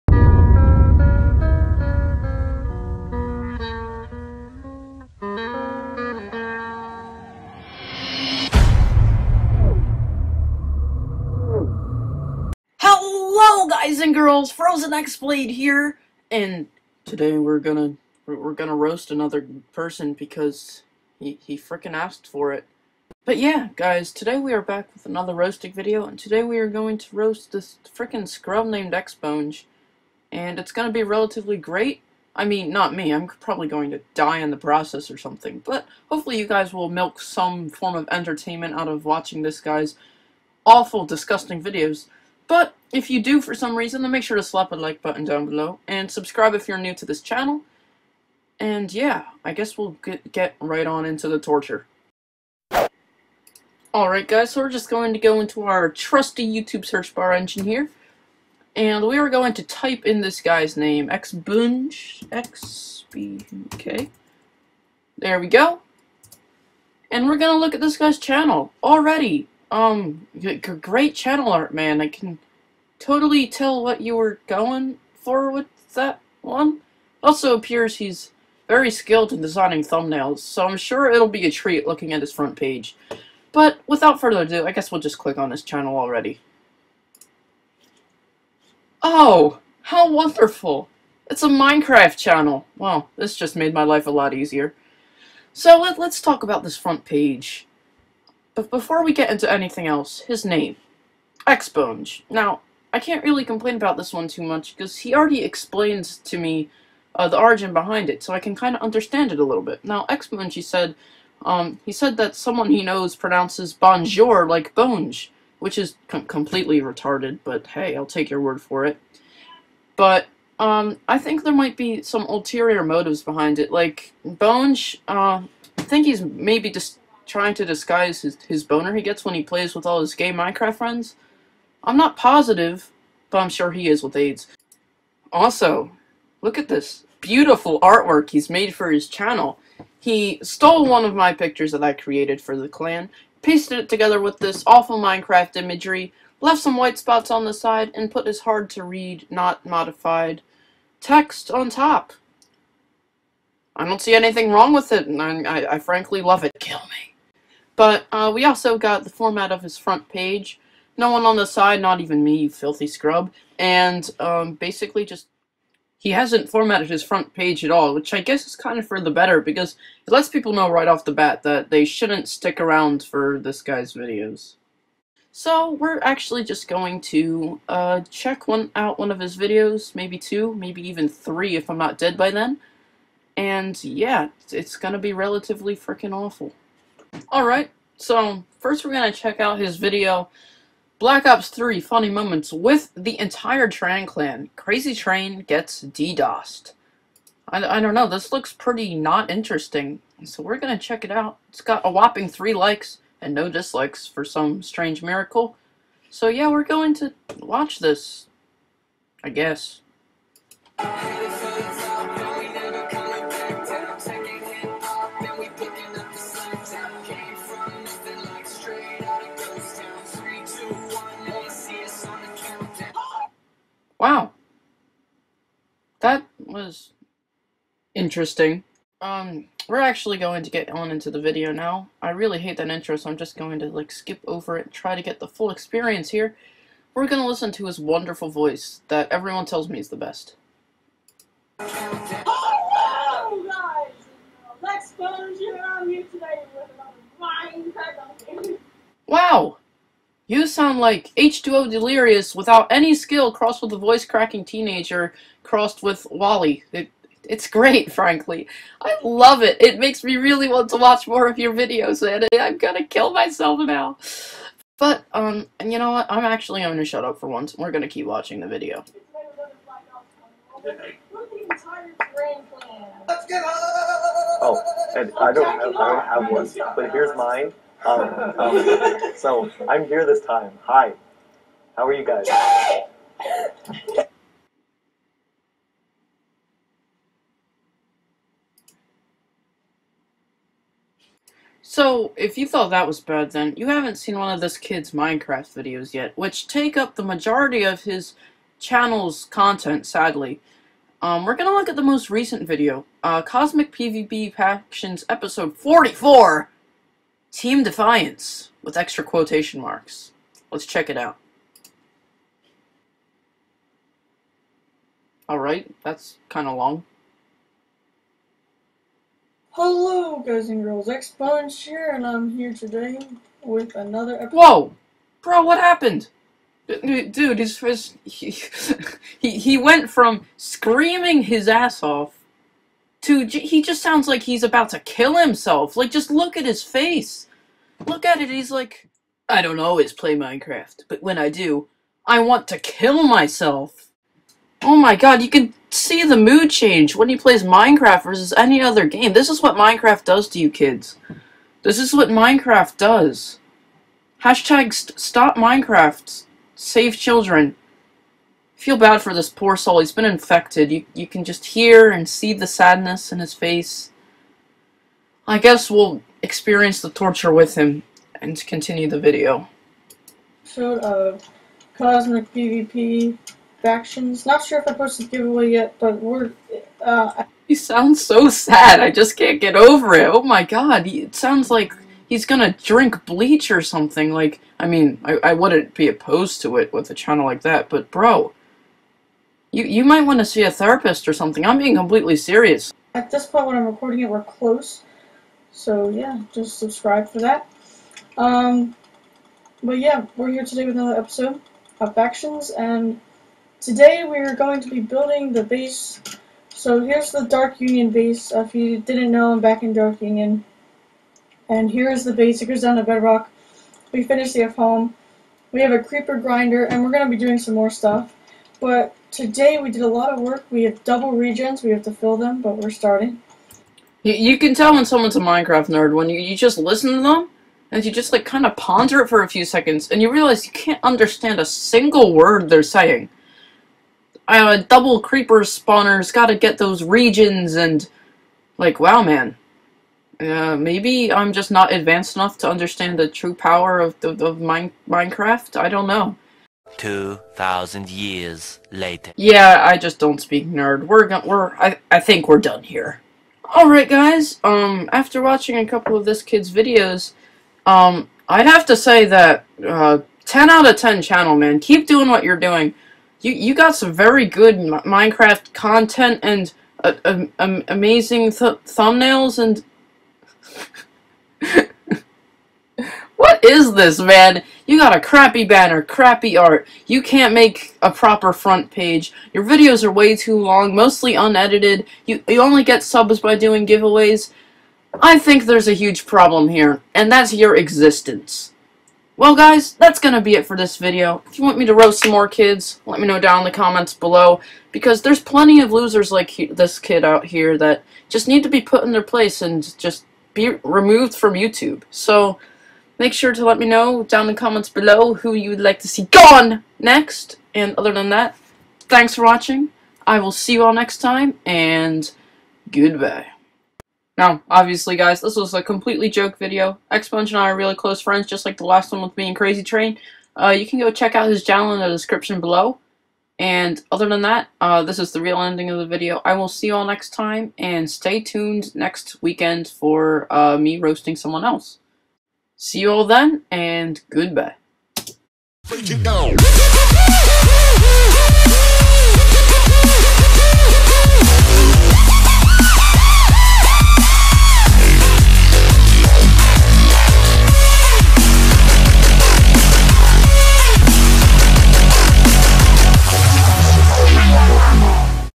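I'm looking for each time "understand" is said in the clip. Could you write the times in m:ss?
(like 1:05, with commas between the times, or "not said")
1:48, 7:10, 7:22.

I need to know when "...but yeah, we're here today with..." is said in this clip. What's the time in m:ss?
6:39.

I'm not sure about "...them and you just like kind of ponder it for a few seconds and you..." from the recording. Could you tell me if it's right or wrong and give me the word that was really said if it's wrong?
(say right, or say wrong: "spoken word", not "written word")
right.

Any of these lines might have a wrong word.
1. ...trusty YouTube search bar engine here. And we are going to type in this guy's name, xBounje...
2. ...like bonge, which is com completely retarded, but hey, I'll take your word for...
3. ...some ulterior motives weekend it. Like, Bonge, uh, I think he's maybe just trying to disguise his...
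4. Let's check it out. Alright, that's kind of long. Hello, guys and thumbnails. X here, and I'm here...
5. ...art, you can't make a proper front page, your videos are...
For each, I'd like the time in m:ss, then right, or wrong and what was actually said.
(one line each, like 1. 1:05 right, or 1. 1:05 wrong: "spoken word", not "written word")
1. 0:55 right
2. 1:54 right
3. 2:02 wrong: "behind", not "weekend"
4. 5:10 wrong: "girls", not "thumbnails"
5. 7:56 right.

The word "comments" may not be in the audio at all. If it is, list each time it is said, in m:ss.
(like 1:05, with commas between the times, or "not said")
8:13, 8:24.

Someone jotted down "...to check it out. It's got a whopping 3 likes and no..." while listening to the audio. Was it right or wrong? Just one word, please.
right.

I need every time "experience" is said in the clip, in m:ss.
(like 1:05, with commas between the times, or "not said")
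3:55, 6:06.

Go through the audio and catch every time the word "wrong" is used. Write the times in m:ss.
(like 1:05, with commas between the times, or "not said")
2:34.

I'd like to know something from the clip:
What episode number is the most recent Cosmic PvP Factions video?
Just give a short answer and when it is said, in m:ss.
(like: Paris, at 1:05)
44, at 5:05.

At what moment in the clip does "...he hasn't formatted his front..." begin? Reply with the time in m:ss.
2:45.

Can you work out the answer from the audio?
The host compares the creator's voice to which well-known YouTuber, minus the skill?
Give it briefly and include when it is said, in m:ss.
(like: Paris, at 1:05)
H2O Delirious, at 4:11.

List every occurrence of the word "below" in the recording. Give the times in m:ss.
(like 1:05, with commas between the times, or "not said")
0:45, 8:13, 8:24, 8:42.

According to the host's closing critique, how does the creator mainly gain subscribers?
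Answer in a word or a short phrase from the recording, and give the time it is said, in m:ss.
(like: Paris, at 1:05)
doing giveaways, at 8:03.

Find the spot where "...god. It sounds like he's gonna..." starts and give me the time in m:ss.
6:20.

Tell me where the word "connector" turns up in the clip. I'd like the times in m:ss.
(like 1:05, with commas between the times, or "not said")
not said.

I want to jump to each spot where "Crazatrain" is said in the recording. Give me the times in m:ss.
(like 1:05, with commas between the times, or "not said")
3:14, 8:39.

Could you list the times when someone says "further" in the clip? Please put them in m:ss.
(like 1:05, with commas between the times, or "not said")
1:24.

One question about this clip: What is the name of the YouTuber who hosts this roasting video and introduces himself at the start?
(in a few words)
Frozen Xblade.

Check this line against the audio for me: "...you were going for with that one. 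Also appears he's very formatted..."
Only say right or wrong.
wrong.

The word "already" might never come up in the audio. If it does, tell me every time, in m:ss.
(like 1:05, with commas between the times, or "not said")
1:08, 1:25, 1:45.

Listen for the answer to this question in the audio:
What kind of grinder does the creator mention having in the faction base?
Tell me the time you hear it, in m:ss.
6:55.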